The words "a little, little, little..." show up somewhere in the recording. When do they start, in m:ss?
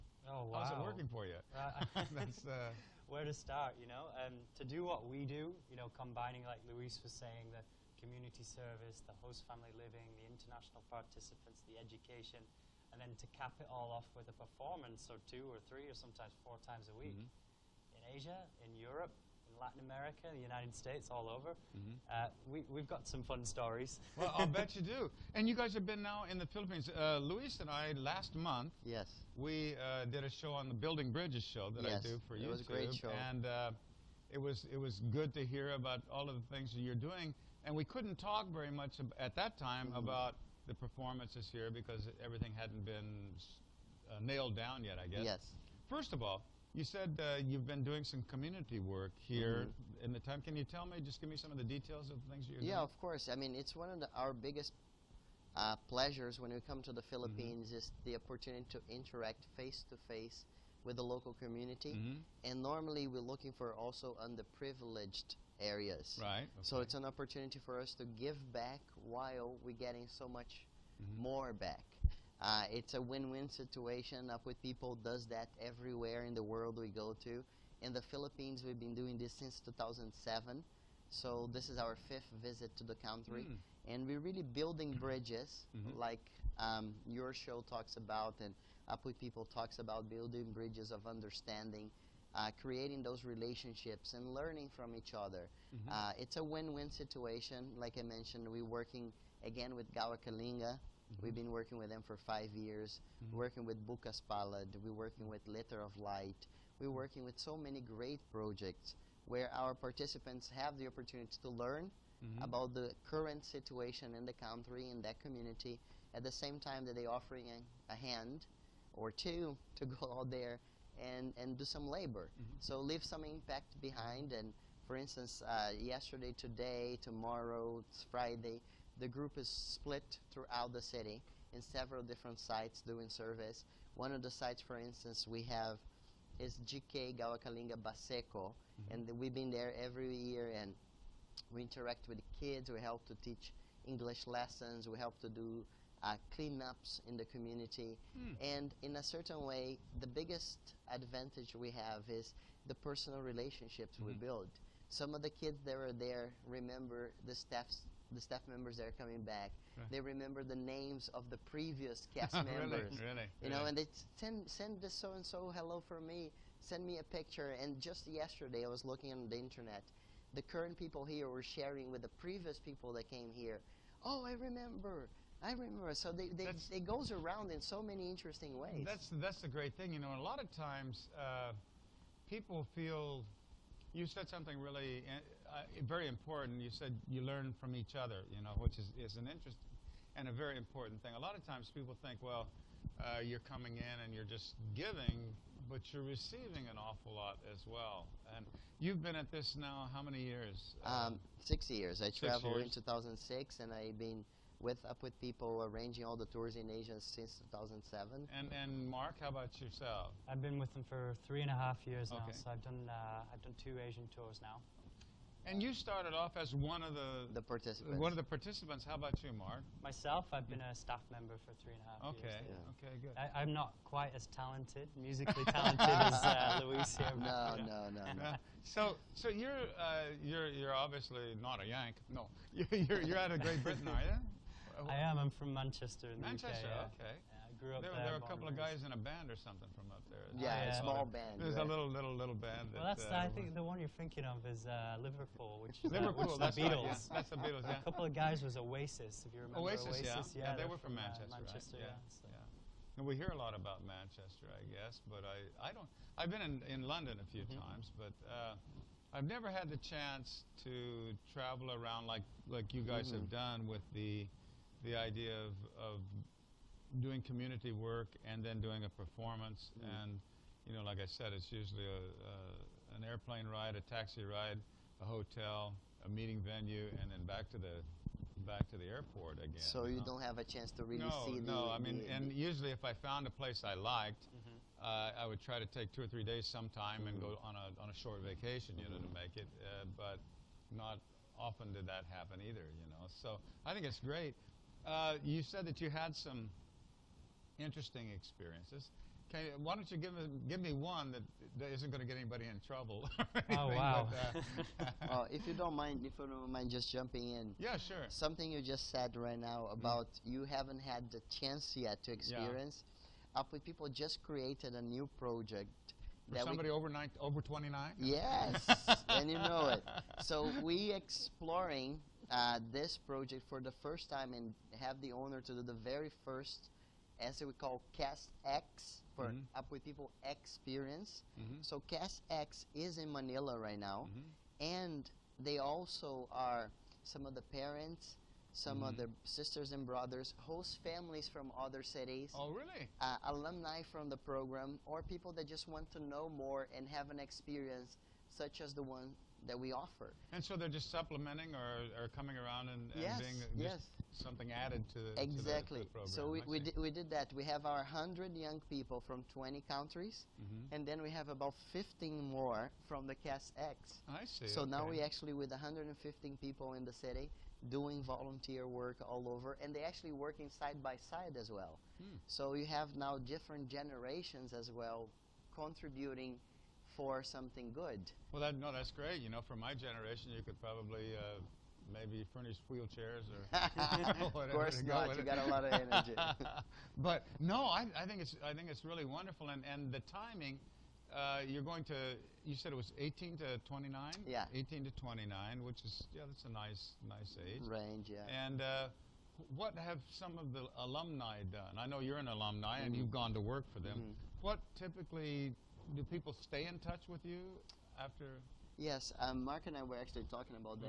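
4:01.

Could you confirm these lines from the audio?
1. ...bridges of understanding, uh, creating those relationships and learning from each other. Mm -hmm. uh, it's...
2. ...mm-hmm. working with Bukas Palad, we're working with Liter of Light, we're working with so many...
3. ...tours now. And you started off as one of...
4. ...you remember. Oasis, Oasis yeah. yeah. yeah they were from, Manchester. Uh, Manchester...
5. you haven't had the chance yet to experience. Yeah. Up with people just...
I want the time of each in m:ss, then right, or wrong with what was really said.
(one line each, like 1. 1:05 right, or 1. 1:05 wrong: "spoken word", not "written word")
1. 1:30 right
2. 1:43 right
3. 3:34 right
4. 4:09 right
5. 5:10 right.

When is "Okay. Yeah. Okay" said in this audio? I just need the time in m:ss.
3:42.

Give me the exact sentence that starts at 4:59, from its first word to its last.
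Okay, why don't you give, give me one that, that isn't going to get anybody in trouble?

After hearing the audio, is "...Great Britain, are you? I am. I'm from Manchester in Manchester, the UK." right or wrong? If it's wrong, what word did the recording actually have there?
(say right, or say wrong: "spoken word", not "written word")
right.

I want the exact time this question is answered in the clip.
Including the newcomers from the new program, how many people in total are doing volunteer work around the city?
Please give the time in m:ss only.
6:05.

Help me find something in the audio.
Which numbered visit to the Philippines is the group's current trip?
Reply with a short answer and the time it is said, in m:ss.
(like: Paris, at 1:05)
fifth, at 1:22.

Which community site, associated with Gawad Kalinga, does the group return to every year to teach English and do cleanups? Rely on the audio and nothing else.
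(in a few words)
Baseco.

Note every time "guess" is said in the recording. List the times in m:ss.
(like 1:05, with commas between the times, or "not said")
0:45, 4:14.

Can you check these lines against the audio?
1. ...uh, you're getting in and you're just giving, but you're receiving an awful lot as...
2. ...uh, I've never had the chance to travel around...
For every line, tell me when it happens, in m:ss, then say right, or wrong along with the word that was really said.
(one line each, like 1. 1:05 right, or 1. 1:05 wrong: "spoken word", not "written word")
1. 3:12 wrong: "coming", not "getting"
2. 4:18 right.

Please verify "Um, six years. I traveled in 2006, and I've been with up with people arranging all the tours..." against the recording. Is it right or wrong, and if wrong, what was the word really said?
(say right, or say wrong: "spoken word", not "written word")
right.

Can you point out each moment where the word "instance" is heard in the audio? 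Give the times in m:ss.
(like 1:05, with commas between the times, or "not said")
2:04, 2:14.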